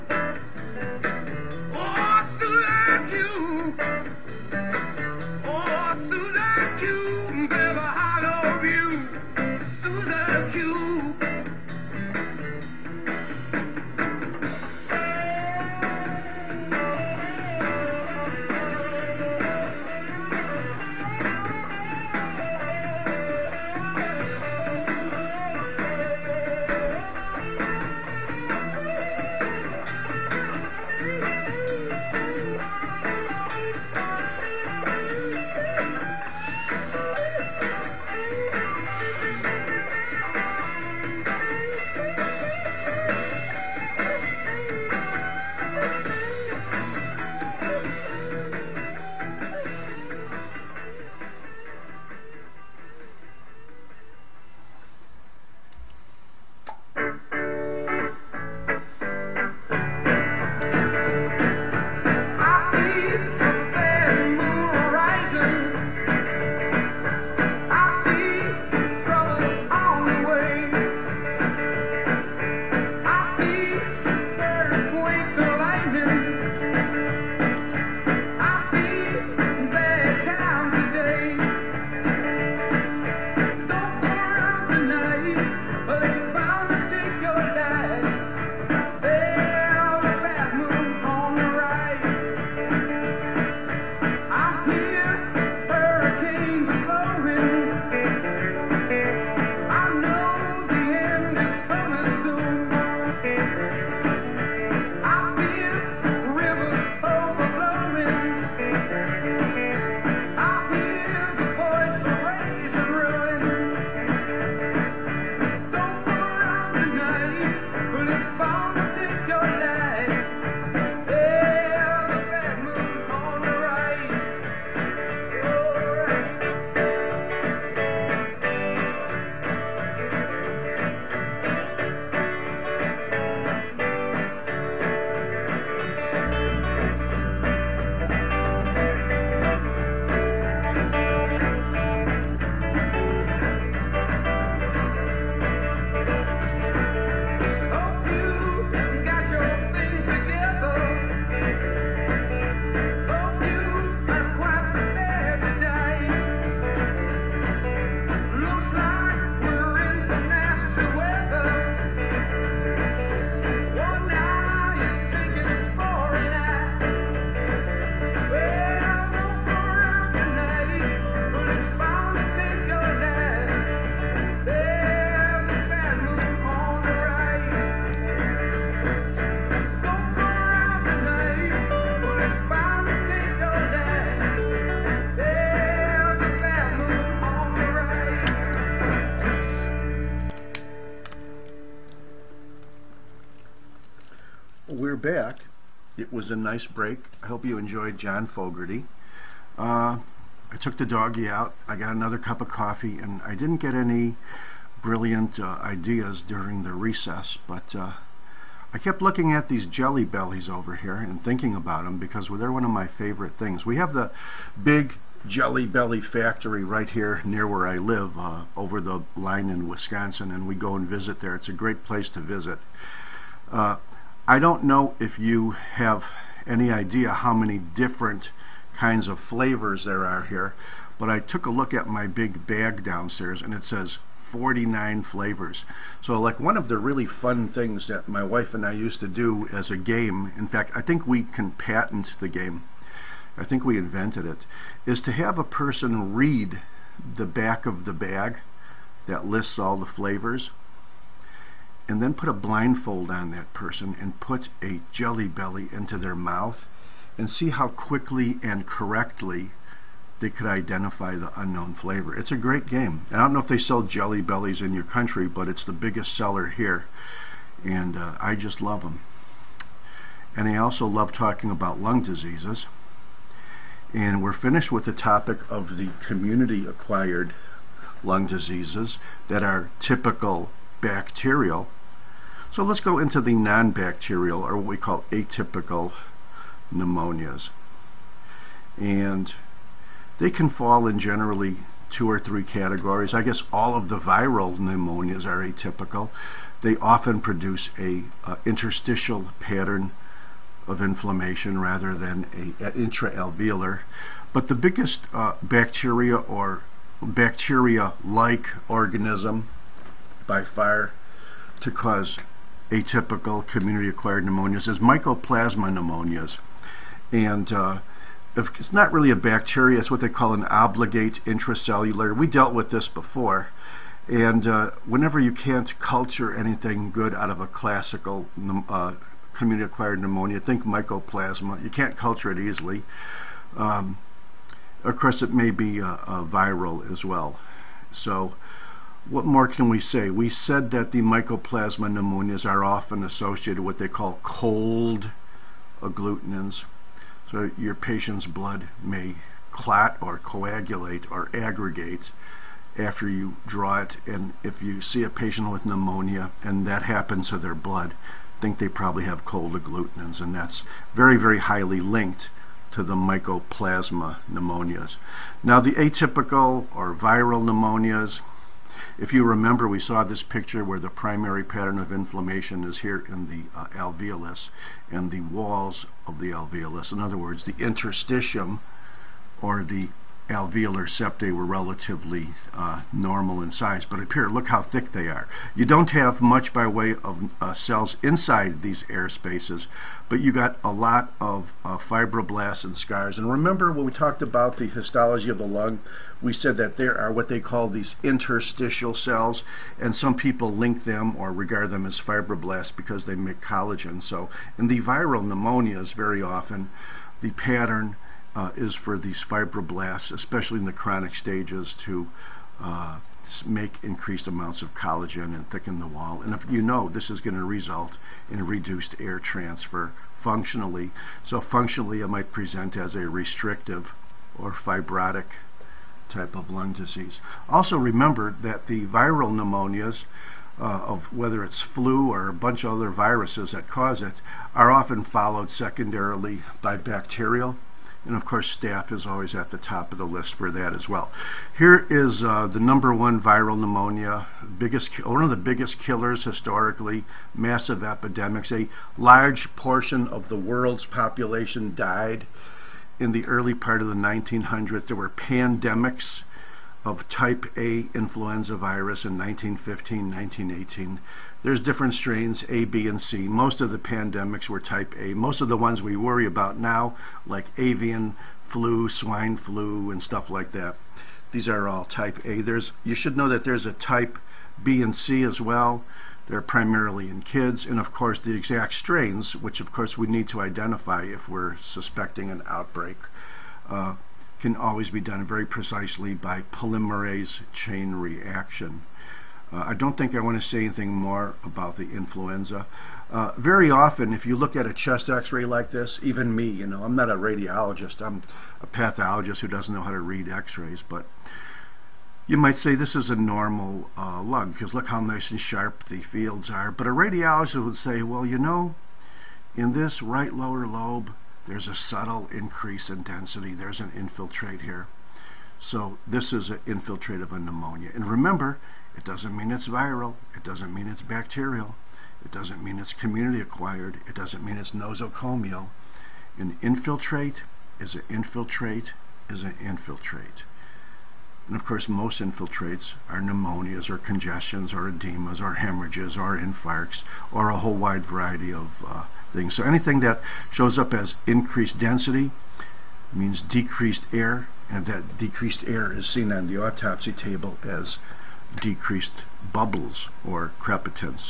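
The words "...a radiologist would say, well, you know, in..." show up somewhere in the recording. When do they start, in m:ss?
8:26.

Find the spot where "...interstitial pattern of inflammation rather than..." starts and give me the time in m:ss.
4:58.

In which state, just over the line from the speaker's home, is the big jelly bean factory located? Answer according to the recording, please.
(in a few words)
Wisconsin.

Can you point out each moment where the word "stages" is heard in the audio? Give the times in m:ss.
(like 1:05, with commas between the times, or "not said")
6:51.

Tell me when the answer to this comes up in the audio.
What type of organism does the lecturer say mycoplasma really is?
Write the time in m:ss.
5:20.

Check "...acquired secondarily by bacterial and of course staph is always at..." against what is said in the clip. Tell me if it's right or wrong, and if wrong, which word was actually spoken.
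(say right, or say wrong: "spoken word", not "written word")
wrong: "followed", not "acquired".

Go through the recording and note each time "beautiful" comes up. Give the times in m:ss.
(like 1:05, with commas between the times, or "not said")
not said.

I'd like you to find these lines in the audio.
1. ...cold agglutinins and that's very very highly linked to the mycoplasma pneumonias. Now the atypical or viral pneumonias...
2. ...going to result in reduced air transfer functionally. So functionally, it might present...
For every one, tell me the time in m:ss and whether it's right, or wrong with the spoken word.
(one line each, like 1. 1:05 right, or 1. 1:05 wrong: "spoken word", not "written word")
1. 5:59 right
2. 6:57 right.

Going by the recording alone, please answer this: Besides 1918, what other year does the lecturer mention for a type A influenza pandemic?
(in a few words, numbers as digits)
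1915.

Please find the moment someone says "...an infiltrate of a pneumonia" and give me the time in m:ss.
8:36.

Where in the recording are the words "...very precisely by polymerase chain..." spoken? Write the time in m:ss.
8:05.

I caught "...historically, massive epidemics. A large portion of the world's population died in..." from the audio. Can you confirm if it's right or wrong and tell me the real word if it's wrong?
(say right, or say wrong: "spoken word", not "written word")
right.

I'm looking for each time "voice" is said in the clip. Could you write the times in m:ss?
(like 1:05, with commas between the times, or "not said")
not said.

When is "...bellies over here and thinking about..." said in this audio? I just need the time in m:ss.
3:30.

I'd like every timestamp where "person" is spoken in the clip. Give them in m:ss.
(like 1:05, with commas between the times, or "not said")
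4:05, 4:13.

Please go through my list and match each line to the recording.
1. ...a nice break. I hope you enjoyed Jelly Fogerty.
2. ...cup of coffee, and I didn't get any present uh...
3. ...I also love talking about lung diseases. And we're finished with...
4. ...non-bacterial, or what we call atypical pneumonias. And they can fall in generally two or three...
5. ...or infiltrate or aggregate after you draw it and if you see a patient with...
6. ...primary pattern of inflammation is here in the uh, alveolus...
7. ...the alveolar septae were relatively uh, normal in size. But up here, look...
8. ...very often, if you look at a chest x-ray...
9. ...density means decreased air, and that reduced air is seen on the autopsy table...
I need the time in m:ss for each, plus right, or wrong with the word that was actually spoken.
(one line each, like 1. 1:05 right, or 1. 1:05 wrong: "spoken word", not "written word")
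1. 3:16 wrong: "John", not "Jelly"
2. 3:22 wrong: "brilliant", not "present"
3. 4:30 right
4. 4:43 right
5. 5:50 wrong: "coagulate", not "infiltrate"
6. 6:10 right
7. 6:19 right
8. 8:13 right
9. 9:01 wrong: "decreased", not "reduced".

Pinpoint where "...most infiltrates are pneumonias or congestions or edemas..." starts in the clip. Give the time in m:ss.
8:51.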